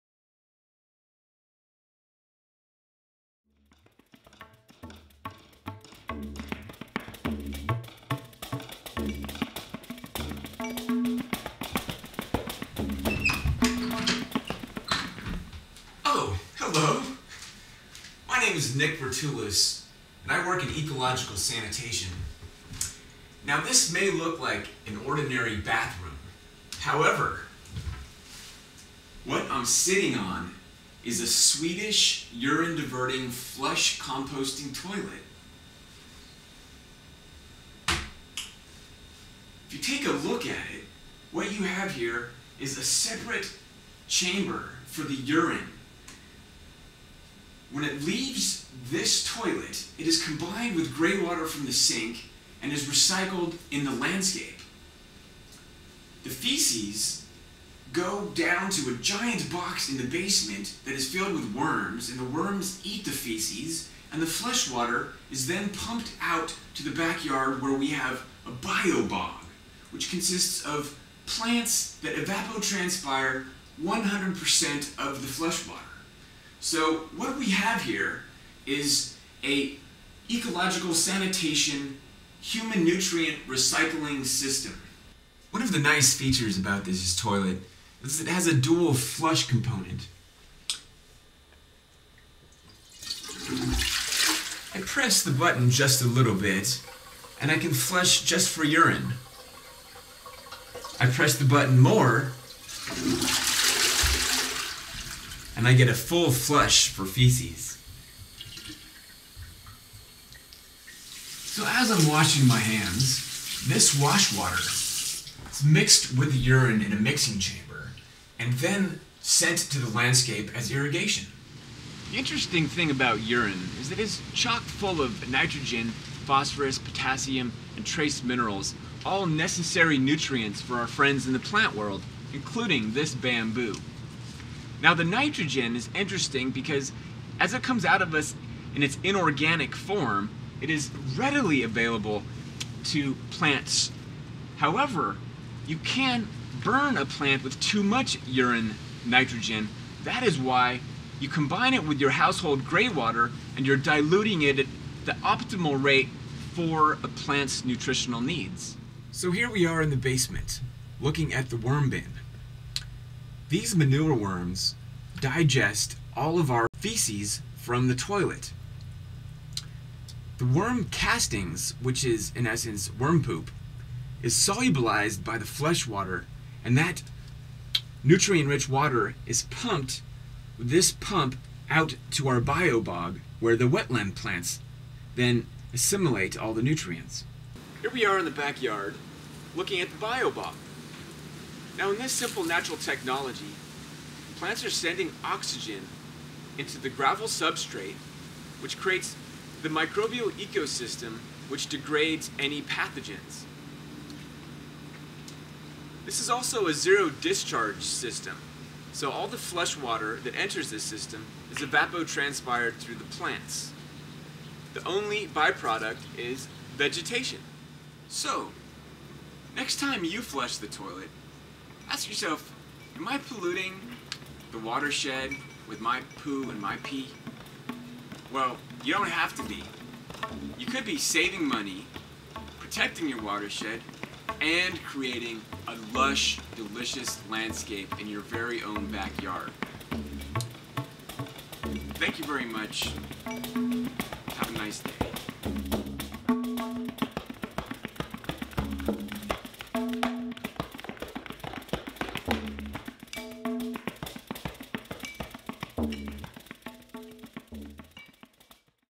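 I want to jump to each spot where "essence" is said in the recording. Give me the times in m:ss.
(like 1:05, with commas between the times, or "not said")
2:52.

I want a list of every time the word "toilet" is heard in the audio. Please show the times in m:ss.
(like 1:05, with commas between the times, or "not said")
0:34, 0:49, 1:27, 2:47, 3:40.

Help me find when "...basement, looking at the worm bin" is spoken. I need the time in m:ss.
2:39.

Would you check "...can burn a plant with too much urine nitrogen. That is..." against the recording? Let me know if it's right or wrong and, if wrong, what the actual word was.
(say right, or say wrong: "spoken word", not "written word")
right.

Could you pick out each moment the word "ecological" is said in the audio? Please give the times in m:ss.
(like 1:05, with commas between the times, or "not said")
0:20, 1:20.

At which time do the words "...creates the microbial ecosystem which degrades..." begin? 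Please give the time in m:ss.
3:18.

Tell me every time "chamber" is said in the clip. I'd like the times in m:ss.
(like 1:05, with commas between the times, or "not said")
0:44, 1:57.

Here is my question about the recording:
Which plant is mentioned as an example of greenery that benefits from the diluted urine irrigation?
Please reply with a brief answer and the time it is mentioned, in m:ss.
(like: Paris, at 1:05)
bamboo, at 2:13.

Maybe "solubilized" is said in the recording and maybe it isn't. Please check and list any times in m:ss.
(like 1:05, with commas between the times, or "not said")
2:54.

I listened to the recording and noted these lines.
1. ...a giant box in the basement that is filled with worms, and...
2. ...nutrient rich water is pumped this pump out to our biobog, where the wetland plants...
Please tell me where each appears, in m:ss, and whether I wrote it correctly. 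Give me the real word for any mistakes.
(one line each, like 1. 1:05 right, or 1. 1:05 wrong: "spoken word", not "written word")
1. 0:58 right
2. 2:58 right.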